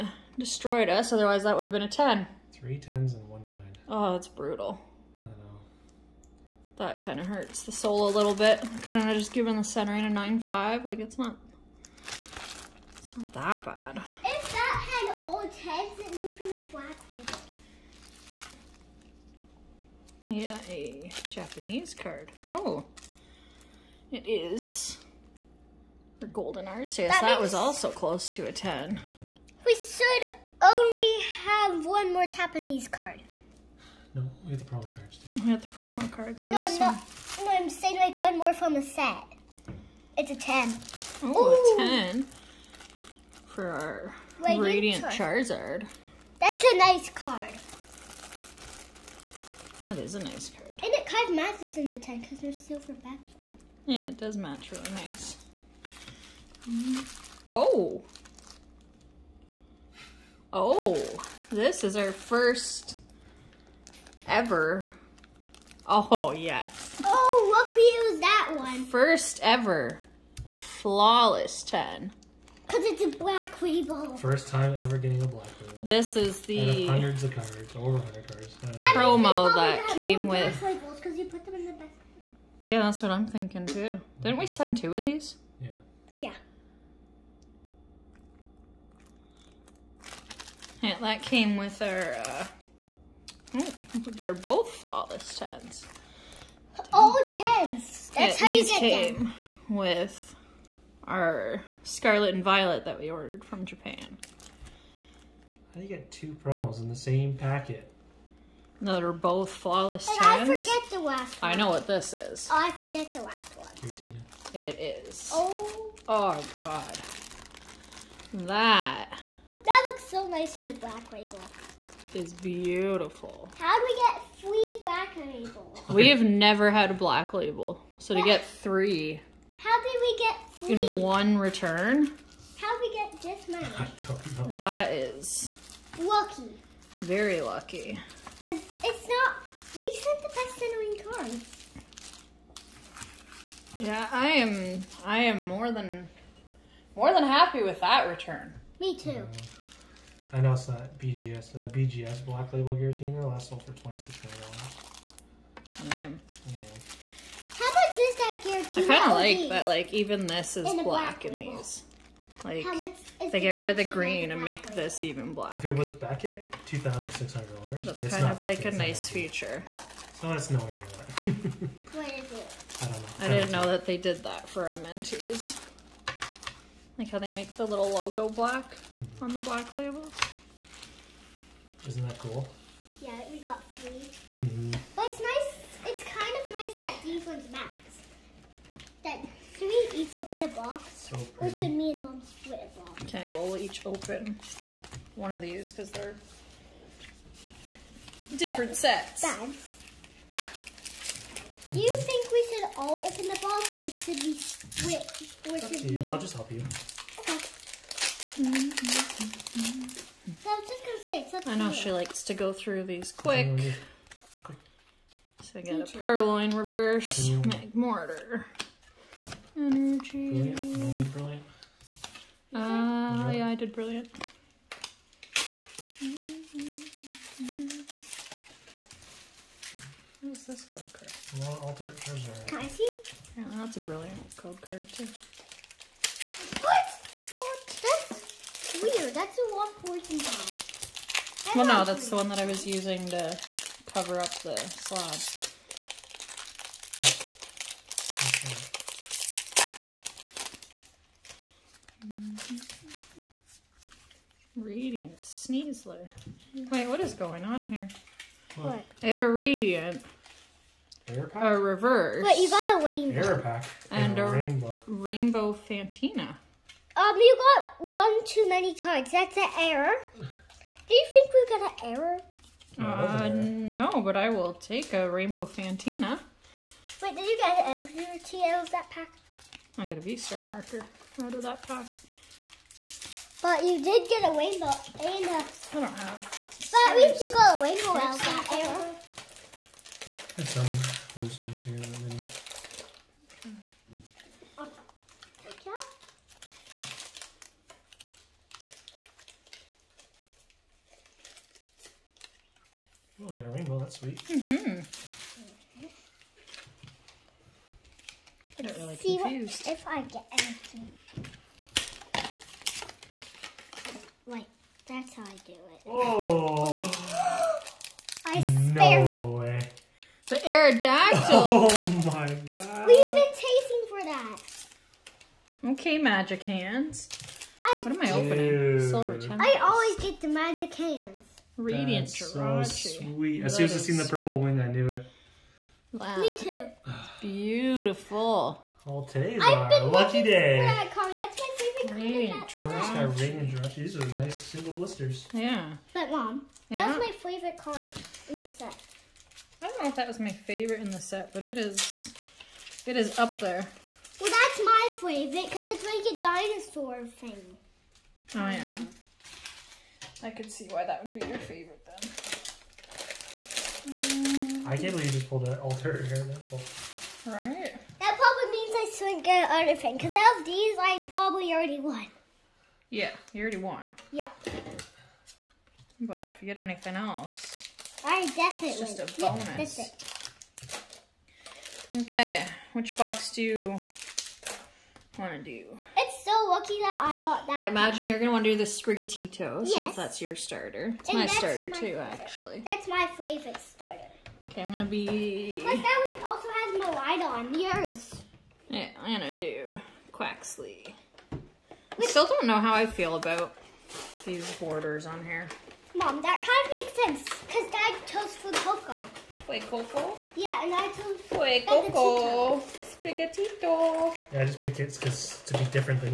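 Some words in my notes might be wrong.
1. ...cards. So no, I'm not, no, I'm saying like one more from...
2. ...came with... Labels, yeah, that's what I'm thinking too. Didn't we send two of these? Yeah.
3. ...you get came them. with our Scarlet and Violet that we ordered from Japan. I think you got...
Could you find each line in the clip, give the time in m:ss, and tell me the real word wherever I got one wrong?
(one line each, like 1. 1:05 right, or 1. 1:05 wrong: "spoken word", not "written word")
1. 0:36 right
2. 1:19 right
3. 1:38 right.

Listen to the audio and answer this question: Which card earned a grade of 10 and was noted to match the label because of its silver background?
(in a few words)
Radiant Charizard.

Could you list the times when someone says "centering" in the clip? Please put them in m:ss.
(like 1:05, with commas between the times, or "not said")
0:09, 2:20.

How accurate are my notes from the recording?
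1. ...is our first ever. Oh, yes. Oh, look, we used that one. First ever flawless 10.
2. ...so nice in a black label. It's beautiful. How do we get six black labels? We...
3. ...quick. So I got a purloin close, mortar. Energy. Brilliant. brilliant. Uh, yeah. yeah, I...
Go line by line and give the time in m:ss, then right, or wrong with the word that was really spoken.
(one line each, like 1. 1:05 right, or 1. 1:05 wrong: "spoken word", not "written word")
1. 1:01 right
2. 2:00 wrong: "three", not "six"
3. 3:33 wrong: "reverse", not "close".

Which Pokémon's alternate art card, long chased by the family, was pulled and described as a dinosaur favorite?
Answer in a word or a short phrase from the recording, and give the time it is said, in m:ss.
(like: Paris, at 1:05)
Aerodactyl, at 5:20.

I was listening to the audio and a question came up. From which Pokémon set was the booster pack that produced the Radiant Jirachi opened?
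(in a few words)
Silver Tempest.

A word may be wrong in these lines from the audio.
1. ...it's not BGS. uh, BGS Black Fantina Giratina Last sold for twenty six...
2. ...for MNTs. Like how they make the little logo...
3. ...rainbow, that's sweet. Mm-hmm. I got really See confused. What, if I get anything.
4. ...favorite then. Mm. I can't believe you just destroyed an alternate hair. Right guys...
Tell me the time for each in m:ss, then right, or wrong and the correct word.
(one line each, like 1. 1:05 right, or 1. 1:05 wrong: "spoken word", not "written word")
1. 2:30 wrong: "Label", not "Fantina"
2. 2:54 right
3. 5:03 right
4. 6:01 wrong: "pulled", not "destroyed".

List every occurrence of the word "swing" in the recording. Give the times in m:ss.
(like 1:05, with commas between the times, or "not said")
6:08.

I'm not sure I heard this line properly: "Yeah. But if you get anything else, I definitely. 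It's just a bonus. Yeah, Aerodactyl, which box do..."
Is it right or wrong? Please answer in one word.
wrong.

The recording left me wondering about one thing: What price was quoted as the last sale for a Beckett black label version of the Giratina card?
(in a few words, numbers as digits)
$2,600.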